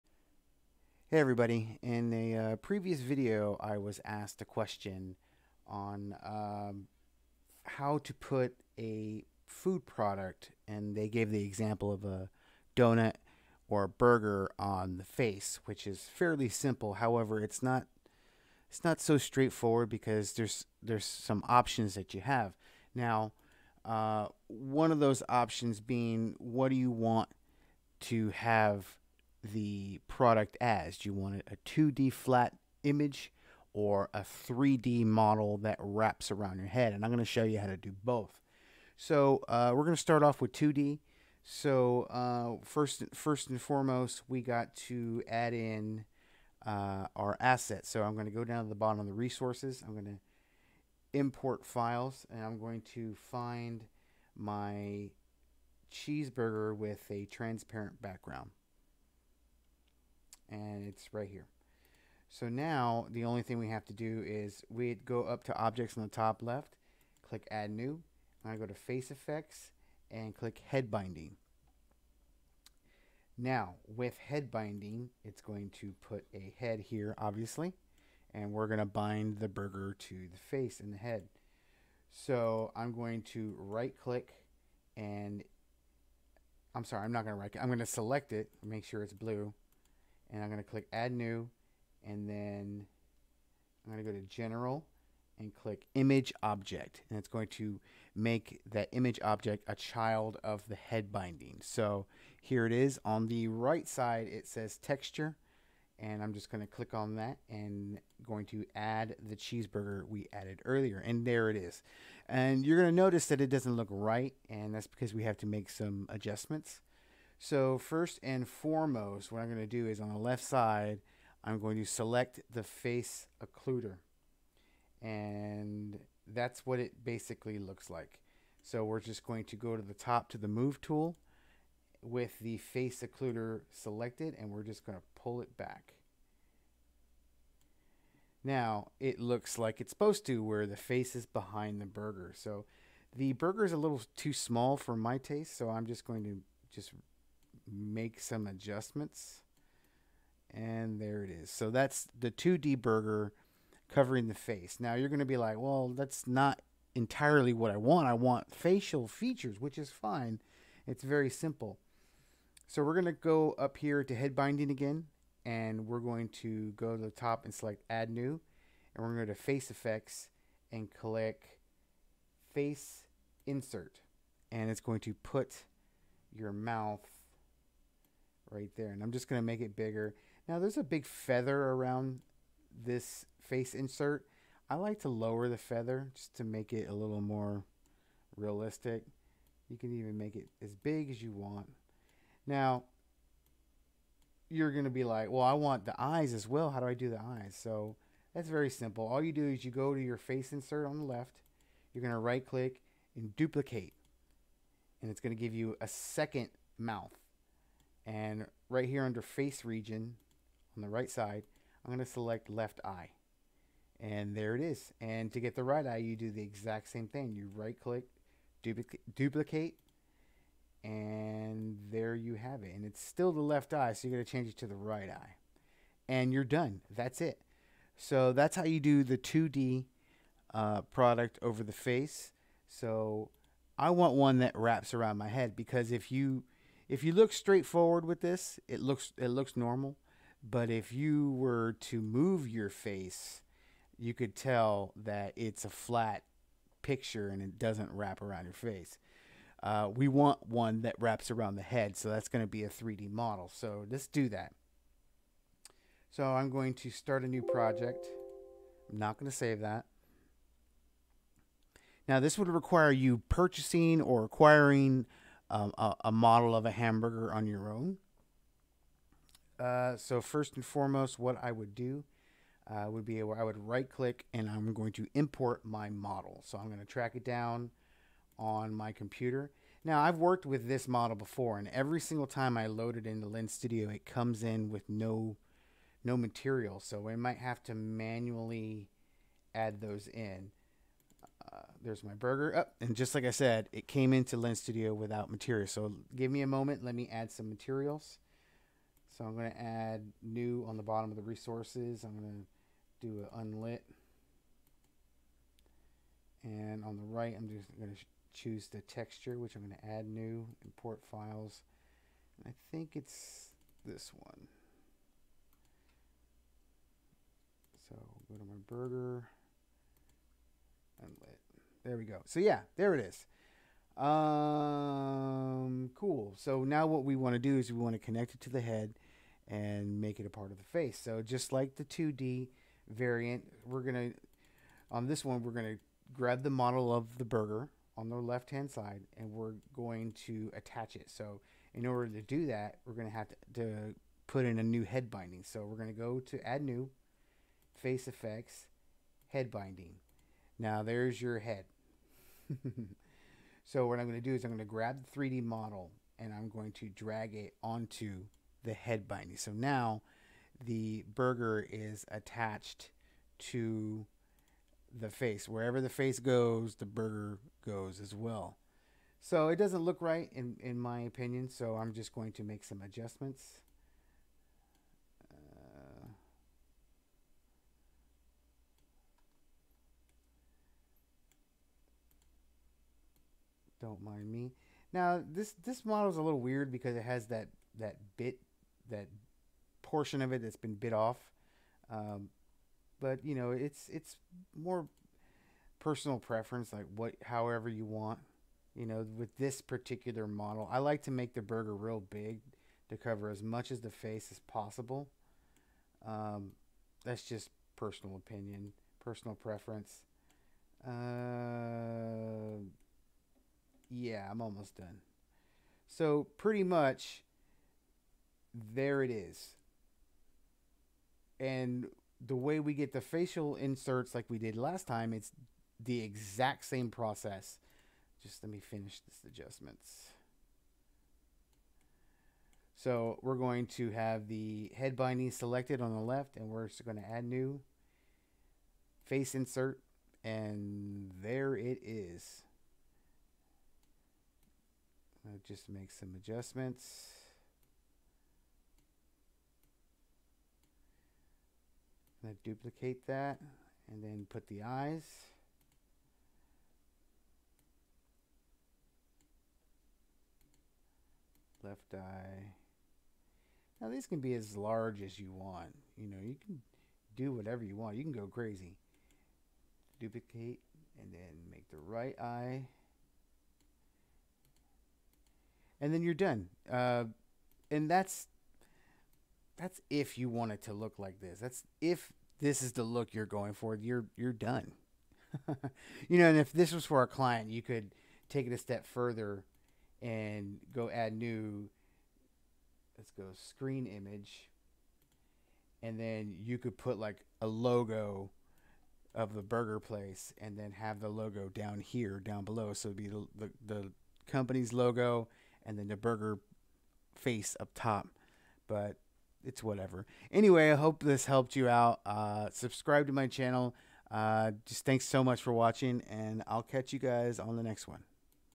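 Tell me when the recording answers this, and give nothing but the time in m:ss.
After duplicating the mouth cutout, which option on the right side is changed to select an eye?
3:29.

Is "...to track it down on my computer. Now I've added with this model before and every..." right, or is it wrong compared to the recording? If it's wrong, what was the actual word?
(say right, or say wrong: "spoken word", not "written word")
wrong: "worked", not "added".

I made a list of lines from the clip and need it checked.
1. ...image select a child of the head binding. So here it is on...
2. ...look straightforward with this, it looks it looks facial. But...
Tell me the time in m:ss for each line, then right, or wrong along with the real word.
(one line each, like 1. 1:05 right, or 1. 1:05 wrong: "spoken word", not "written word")
1. 1:38 wrong: "object", not "select"
2. 3:57 wrong: "normal", not "facial".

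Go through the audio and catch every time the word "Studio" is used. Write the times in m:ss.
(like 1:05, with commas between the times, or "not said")
4:43, 4:54.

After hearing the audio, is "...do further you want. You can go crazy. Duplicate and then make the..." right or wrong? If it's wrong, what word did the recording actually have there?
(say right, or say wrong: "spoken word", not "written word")
wrong: "whatever", not "further".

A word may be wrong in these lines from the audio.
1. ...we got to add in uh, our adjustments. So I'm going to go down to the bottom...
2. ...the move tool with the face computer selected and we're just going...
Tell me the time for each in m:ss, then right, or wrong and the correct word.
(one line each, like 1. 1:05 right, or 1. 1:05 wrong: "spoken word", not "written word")
1. 0:44 wrong: "assets", not "adjustments"
2. 2:10 wrong: "occluder", not "computer".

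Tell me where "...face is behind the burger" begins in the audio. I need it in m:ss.
2:20.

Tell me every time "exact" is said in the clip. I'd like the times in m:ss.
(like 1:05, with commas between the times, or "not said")
3:36, 7:06.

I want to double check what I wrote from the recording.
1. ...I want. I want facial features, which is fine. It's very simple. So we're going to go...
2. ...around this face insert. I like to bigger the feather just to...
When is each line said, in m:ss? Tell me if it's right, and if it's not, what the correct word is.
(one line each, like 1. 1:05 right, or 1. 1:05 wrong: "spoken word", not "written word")
1. 2:37 right
2. 3:01 wrong: "lower", not "bigger".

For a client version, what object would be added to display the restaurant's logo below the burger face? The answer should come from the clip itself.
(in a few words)
Screen image.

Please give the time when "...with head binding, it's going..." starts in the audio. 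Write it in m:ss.
1:13.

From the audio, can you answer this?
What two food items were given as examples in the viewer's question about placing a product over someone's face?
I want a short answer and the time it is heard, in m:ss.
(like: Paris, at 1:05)
A donut or a burger, at 0:12.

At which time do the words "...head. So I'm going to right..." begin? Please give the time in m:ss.
1:20.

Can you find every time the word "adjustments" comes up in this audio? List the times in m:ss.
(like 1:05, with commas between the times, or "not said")
1:56, 2:28, 6:12, 7:09, 7:26.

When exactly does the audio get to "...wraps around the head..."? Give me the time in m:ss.
4:10.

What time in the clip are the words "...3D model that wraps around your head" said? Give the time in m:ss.
0:34.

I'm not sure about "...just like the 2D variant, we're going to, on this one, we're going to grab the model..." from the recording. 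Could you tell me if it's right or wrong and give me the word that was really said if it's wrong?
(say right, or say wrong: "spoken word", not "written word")
right.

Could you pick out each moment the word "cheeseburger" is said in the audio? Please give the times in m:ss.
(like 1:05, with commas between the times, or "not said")
0:55, 1:49.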